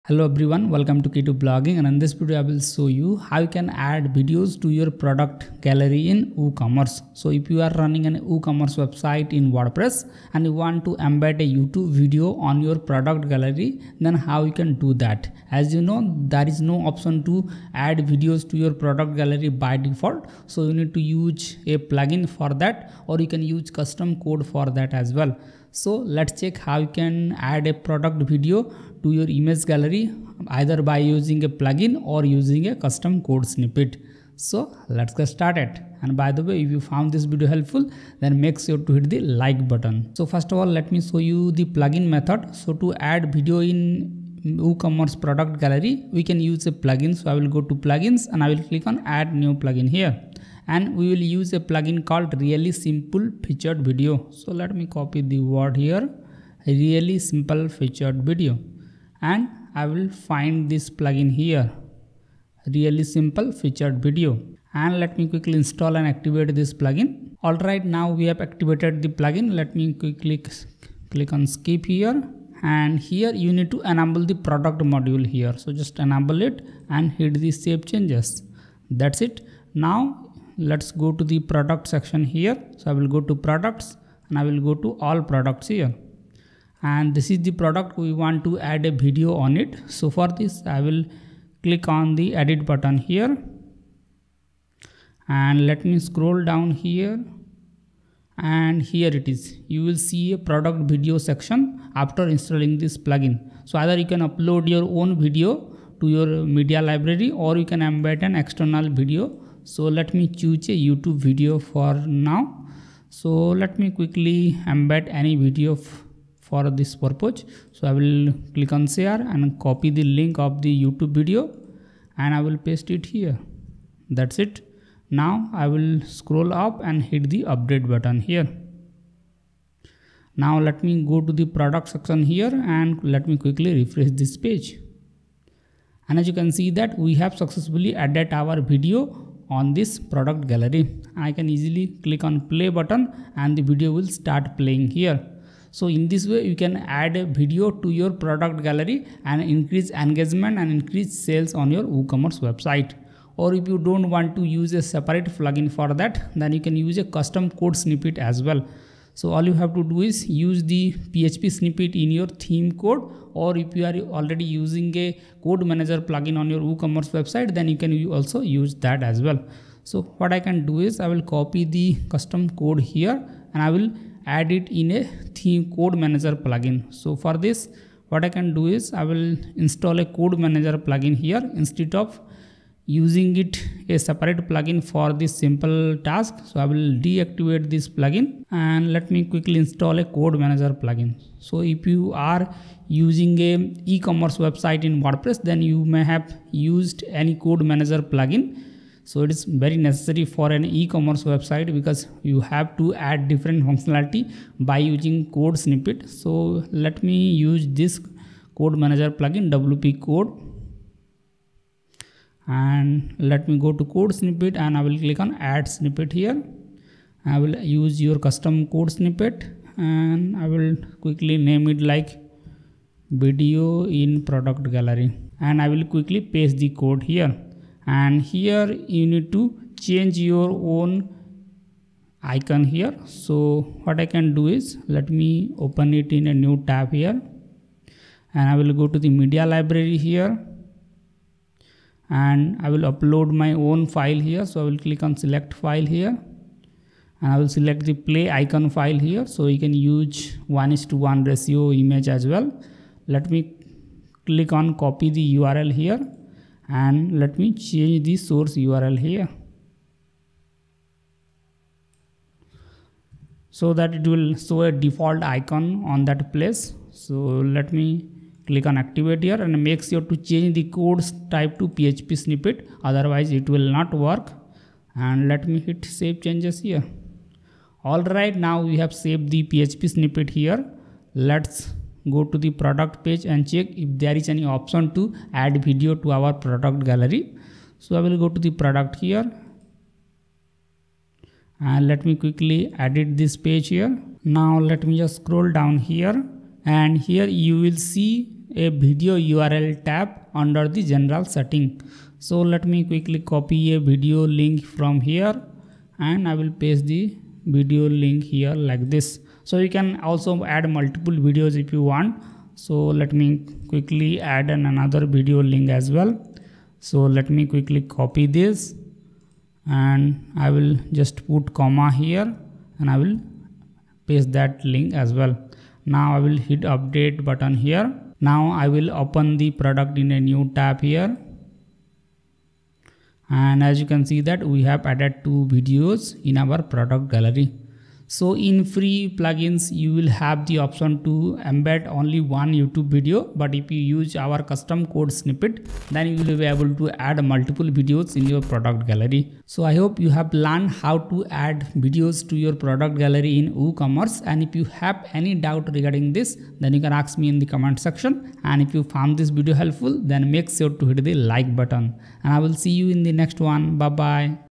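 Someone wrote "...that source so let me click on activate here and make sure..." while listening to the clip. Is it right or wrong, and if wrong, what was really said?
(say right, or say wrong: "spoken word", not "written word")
wrong: "place", not "source".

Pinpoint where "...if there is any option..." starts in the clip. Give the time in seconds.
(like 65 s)
283 s.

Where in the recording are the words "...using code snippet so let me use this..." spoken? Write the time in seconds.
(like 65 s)
204 s.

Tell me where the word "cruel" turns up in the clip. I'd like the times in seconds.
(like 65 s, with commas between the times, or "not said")
not said.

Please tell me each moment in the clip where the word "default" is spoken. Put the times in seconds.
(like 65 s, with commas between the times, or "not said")
19 s, 264 s.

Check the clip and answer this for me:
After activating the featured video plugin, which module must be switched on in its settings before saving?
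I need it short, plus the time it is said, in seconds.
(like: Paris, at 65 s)
Product module, at 74 s.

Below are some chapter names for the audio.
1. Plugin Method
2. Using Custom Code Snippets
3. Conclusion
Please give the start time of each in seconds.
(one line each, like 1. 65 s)
1. 40 s
2. 158 s
3. 337 s.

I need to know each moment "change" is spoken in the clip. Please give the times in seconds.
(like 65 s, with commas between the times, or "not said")
77 s, 229 s, 257 s, 270 s, 276 s.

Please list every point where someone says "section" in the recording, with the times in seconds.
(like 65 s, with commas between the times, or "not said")
81 s, 101 s, 131 s, 357 s.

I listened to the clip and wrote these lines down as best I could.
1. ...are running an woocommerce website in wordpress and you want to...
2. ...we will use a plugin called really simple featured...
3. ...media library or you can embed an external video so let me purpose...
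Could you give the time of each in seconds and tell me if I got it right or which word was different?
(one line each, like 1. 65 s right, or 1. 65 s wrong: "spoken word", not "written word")
1. 7 s right
2. 50 s right
3. 106 s wrong: "choose", not "purpose".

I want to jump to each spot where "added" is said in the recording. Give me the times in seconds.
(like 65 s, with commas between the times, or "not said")
137 s, 334 s.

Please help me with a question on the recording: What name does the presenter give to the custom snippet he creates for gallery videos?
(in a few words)
Video in product gallery.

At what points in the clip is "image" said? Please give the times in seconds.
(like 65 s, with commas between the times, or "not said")
29 s, 251 s.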